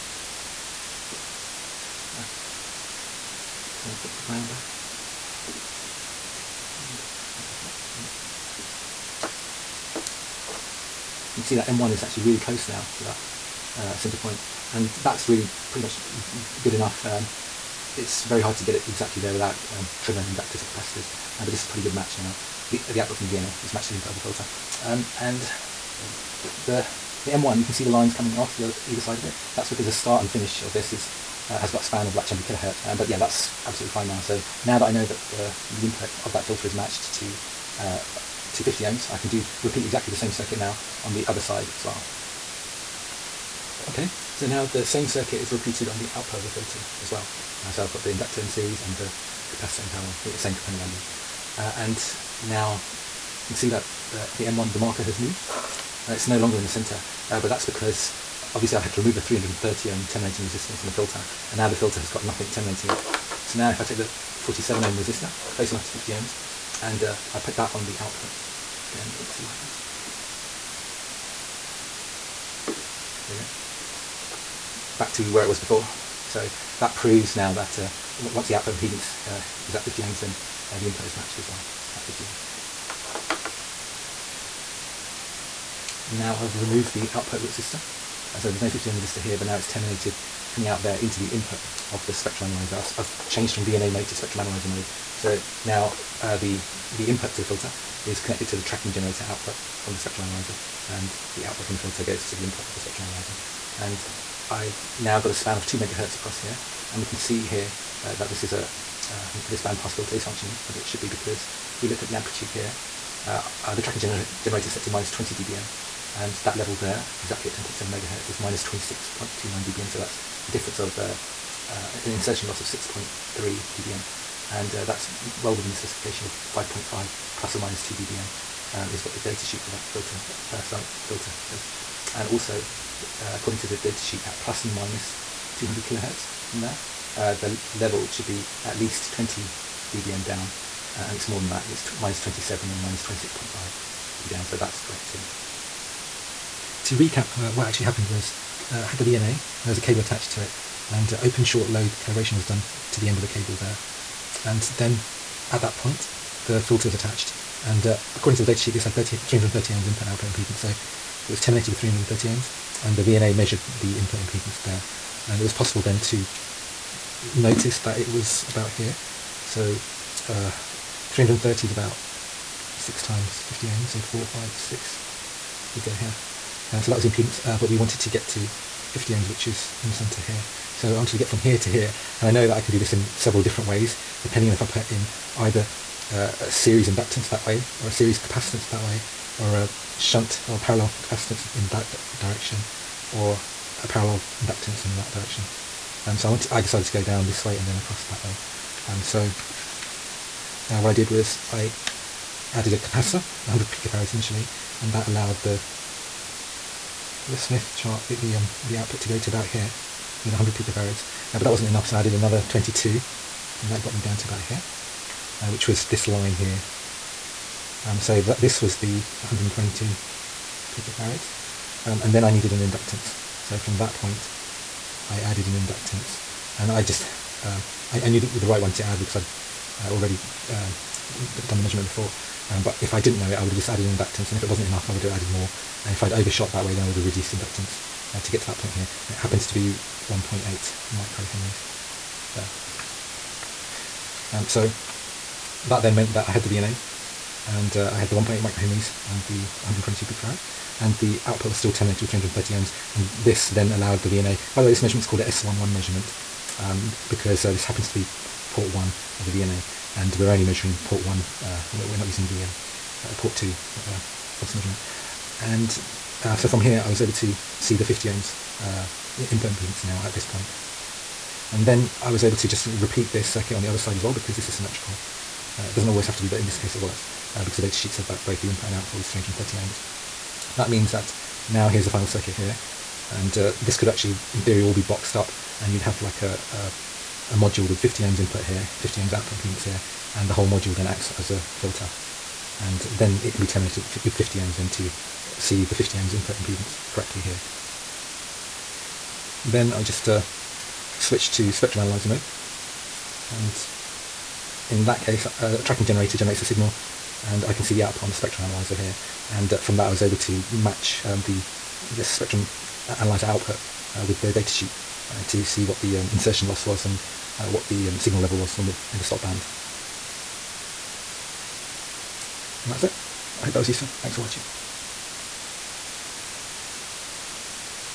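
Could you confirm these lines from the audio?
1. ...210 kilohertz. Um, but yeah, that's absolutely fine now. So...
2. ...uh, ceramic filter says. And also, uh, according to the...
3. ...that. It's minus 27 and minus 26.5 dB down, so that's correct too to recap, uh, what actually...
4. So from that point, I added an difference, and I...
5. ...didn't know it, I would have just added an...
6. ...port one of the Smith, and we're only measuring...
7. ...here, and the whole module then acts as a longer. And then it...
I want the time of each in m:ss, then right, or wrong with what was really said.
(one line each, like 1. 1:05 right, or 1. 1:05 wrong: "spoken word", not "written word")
1. 0:32 wrong: "200", not "210"
2. 2:10 right
3. 2:21 right
4. 3:43 wrong: "inductance", not "difference"
5. 3:52 right
6. 4:18 wrong: "VNA", not "Smith"
7. 4:49 wrong: "filter", not "longer".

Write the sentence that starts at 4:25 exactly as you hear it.
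And uh, so from here, I was able to see the 50 ohms uh, impedance now at this point.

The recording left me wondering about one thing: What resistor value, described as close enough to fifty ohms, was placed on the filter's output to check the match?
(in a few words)
47 ohm.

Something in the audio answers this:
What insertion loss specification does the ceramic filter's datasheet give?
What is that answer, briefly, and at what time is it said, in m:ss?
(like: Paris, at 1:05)
5.5 plus or minus 2 dBm, at 2:06.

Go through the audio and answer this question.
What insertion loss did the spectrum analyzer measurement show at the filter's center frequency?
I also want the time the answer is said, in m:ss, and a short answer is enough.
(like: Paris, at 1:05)
6.3 dBm, at 2:02.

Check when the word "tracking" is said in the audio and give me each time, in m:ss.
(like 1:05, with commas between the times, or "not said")
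1:38, 1:53, 5:05.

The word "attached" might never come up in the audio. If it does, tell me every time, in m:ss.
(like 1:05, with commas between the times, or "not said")
2:29, 2:36.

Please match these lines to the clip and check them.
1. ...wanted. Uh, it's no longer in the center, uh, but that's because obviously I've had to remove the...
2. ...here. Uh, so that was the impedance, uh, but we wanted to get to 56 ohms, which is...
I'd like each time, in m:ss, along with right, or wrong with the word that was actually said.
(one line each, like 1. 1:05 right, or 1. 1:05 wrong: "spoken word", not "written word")
1. 0:55 wrong: "moved", not "wanted"
2. 2:55 wrong: "50", not "56".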